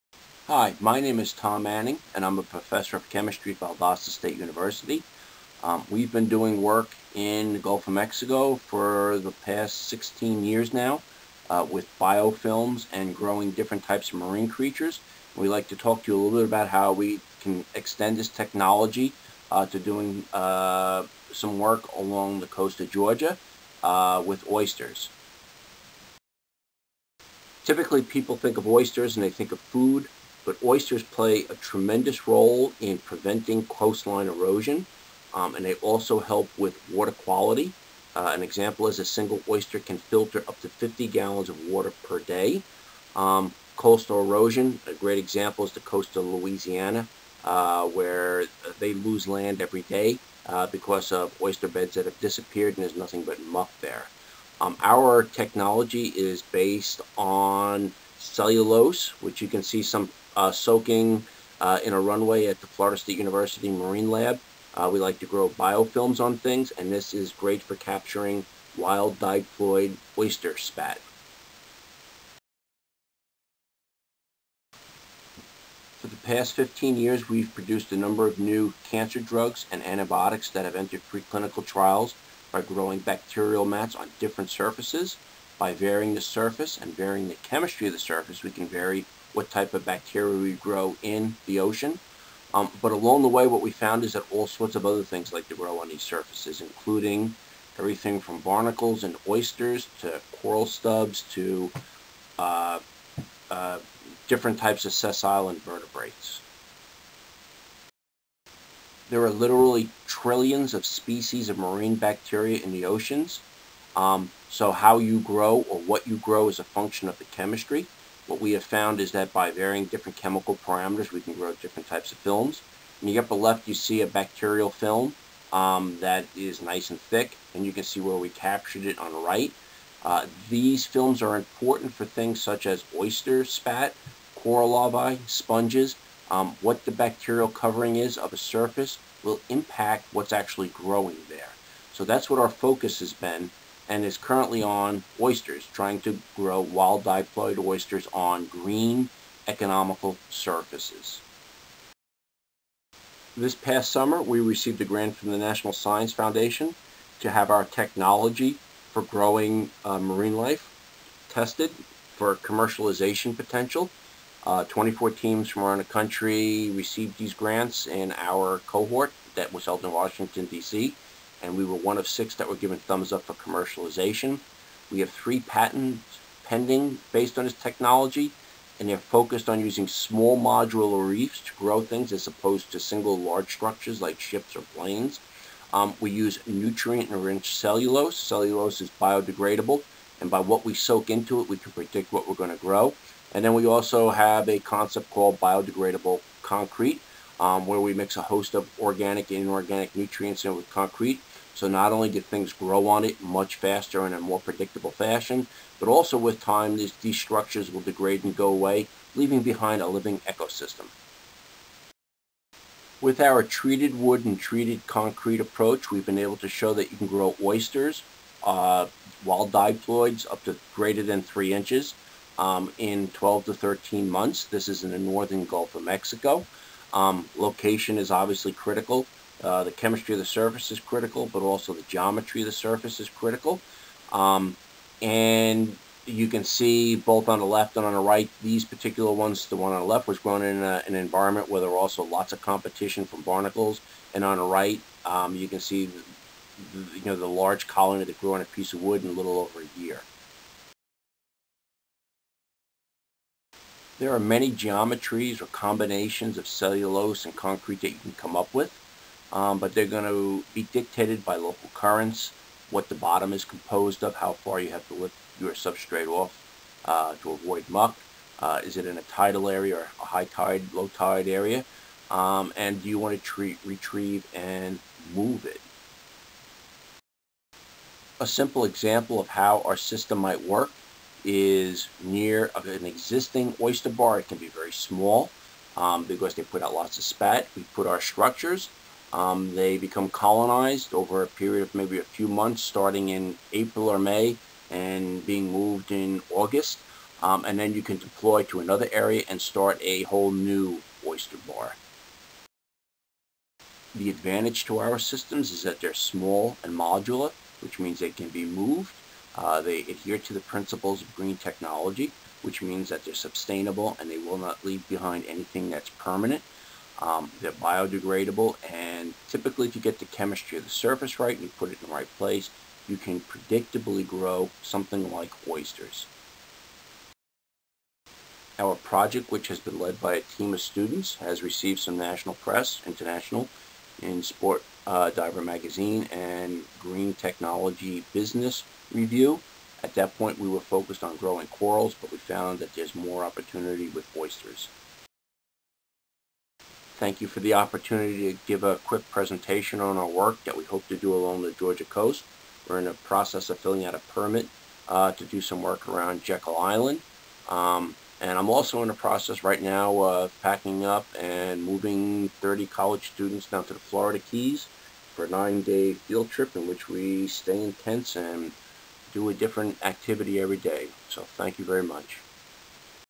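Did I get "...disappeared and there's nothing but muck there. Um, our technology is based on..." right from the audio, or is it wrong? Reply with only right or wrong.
right.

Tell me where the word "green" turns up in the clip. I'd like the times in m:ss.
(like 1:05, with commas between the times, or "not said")
2:28, 5:11, 5:36.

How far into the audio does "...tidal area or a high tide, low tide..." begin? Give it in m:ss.
4:29.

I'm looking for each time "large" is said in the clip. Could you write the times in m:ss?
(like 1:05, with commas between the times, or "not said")
3:03, 4:07.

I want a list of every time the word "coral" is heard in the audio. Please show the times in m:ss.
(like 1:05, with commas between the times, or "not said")
1:40, 2:14, 5:41.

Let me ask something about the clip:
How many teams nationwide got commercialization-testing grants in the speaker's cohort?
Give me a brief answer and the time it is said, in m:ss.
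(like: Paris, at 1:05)
24, at 2:44.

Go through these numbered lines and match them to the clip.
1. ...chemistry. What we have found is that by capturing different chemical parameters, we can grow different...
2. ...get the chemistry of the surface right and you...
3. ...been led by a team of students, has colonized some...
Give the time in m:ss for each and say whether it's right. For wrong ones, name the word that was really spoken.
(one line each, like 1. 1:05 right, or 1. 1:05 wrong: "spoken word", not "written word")
1. 1:57 wrong: "varying", not "capturing"
2. 5:19 right
3. 5:29 wrong: "received", not "colonized".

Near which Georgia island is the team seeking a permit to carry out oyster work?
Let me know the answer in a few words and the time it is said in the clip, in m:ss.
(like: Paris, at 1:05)
Jekyll Island, at 5:56.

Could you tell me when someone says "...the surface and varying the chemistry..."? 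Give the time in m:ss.
1:26.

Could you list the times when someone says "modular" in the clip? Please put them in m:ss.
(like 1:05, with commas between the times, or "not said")
3:00, 5:06.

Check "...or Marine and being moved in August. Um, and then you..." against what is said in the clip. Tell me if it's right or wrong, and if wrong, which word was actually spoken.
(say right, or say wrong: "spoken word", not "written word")
wrong: "May", not "Marine".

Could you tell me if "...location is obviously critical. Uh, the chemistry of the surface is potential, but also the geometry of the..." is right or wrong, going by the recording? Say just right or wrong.
wrong.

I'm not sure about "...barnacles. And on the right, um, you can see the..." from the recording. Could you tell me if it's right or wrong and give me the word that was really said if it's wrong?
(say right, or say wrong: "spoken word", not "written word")
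right.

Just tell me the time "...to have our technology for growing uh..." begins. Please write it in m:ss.
2:37.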